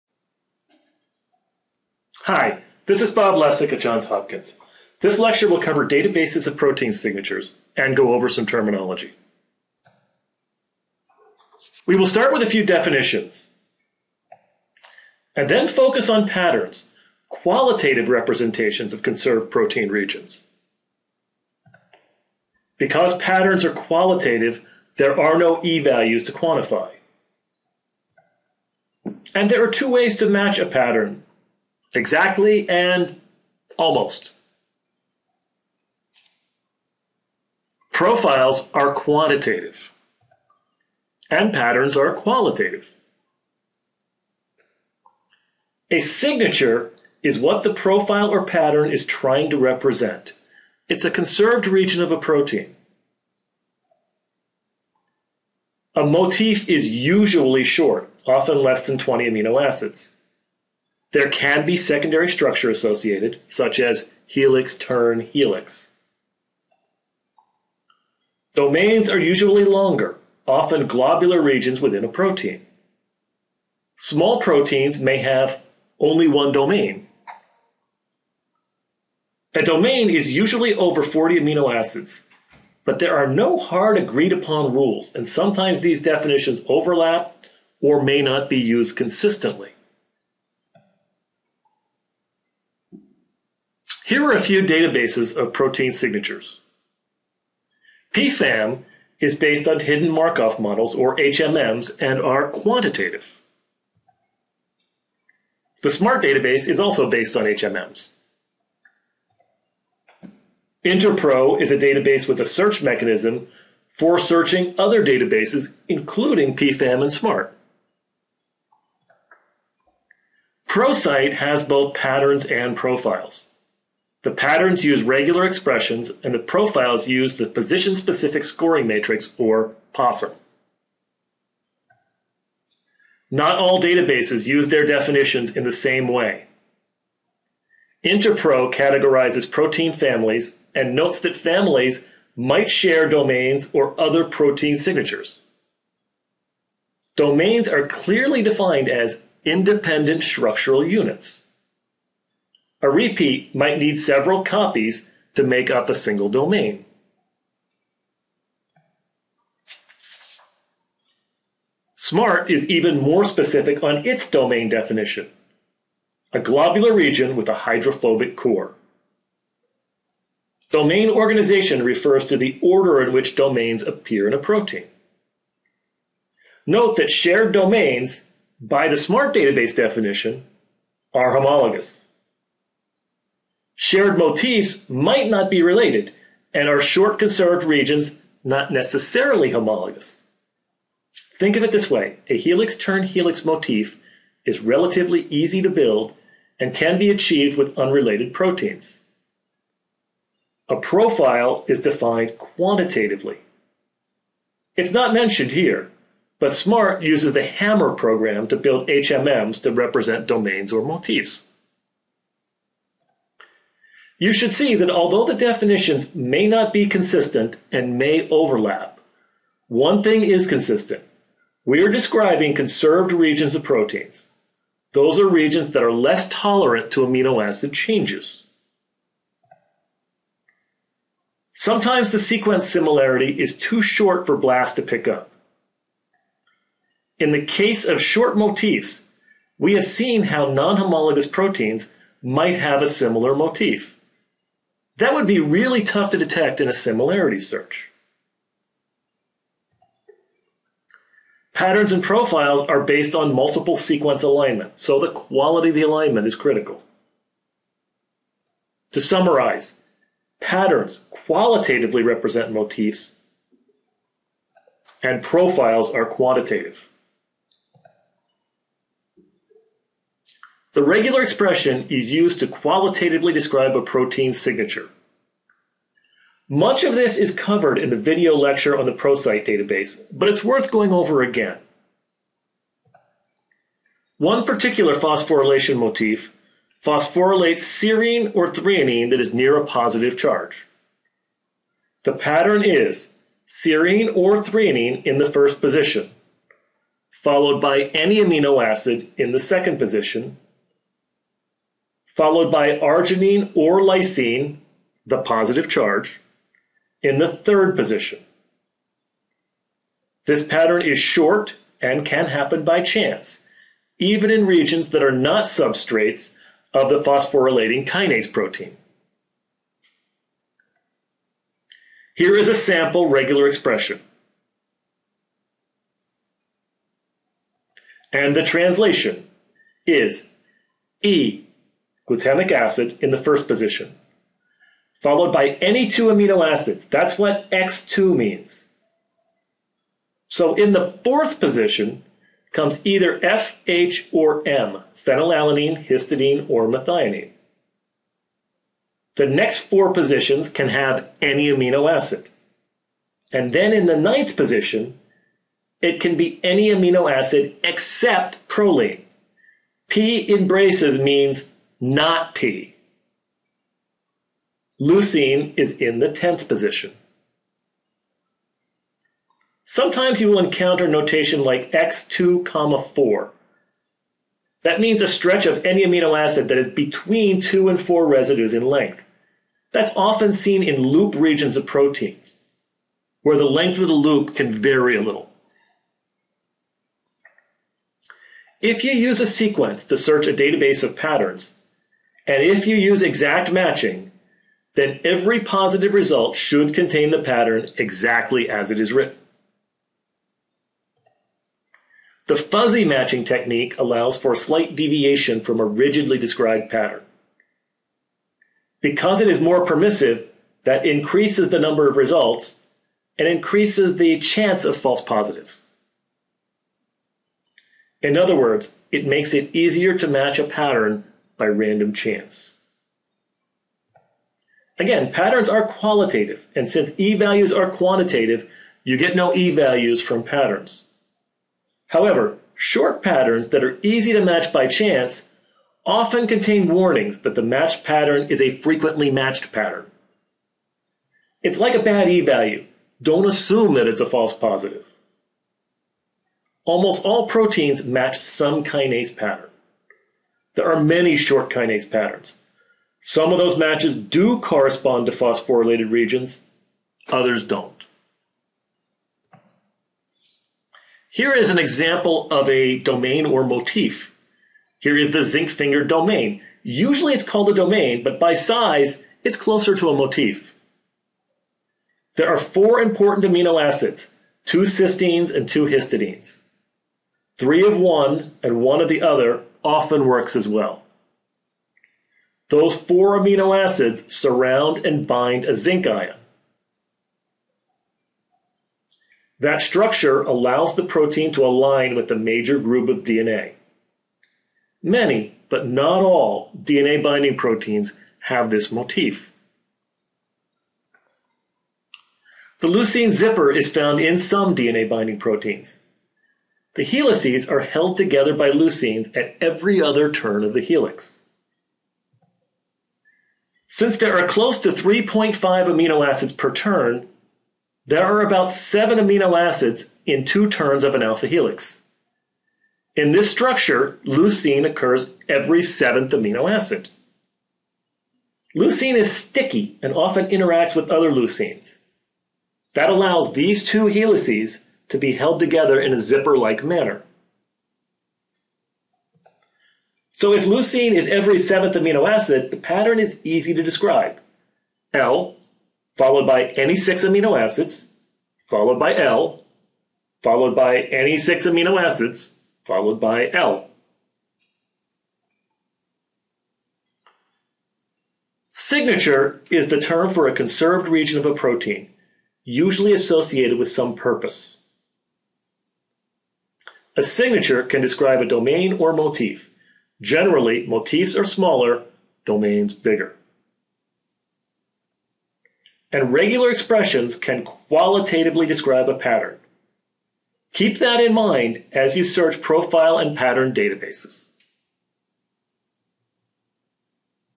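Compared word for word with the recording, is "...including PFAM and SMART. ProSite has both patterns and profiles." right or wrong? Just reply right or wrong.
right.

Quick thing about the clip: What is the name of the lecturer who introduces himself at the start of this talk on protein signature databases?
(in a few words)
Bob Lessig.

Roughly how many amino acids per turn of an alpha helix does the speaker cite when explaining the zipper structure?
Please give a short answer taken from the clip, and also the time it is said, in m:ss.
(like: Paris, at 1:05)
3.5, at 8:34.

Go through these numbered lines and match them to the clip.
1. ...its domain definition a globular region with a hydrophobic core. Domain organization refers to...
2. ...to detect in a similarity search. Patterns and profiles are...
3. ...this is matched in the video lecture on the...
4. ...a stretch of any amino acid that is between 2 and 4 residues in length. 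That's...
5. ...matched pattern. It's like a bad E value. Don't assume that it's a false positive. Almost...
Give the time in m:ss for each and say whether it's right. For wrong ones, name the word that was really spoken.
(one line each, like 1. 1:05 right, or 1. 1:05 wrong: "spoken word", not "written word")
1. 2:44 right
2. 4:06 right
3. 4:36 wrong: "covered", not "matched"
4. 6:15 right
5. 7:19 right.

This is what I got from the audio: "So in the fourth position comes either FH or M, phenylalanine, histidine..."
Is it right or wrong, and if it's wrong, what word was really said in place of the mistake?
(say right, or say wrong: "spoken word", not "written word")
right.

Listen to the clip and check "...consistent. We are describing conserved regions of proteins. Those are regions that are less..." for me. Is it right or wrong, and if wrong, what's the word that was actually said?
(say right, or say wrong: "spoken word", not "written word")
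right.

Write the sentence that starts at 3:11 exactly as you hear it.
Think of it this way a helix turn helix motif is relatively easy to build and can be achieved with unrelated proteins.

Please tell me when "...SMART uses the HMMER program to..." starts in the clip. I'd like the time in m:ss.
3:26.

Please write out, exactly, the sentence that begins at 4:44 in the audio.
One particular phosphorylation motif phosphorylates serine or threonine that is near a positive charge.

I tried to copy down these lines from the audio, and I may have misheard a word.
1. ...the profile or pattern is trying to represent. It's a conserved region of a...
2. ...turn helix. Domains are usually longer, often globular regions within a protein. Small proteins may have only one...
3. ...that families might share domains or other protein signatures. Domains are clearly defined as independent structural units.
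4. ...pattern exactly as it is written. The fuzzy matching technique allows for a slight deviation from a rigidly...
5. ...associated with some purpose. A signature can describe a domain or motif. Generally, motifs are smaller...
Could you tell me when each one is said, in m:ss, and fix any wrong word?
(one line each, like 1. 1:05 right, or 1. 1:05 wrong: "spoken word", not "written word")
1. 0:47 right
2. 1:04 right
3. 2:21 right
4. 6:37 right
5. 9:22 right.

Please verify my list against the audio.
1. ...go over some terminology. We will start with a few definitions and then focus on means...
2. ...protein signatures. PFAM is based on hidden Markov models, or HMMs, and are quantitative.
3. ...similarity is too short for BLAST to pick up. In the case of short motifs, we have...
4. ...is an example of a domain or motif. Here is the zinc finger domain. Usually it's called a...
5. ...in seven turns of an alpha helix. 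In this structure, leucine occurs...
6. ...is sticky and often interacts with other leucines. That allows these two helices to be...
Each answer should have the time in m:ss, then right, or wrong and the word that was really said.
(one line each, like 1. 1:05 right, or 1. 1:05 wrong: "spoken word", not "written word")
1. 0:07 wrong: "patterns", not "means"
2. 1:35 right
3. 3:52 right
4. 7:41 right
5. 8:40 wrong: "two", not "seven"
6. 8:48 right.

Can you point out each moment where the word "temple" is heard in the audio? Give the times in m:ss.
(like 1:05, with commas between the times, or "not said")
not said.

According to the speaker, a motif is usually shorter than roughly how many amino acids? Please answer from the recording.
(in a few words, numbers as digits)
20.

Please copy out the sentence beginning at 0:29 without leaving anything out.
And there are two ways to match a pattern Exactly and almost.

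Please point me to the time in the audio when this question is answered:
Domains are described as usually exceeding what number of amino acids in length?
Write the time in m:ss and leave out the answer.
1:21.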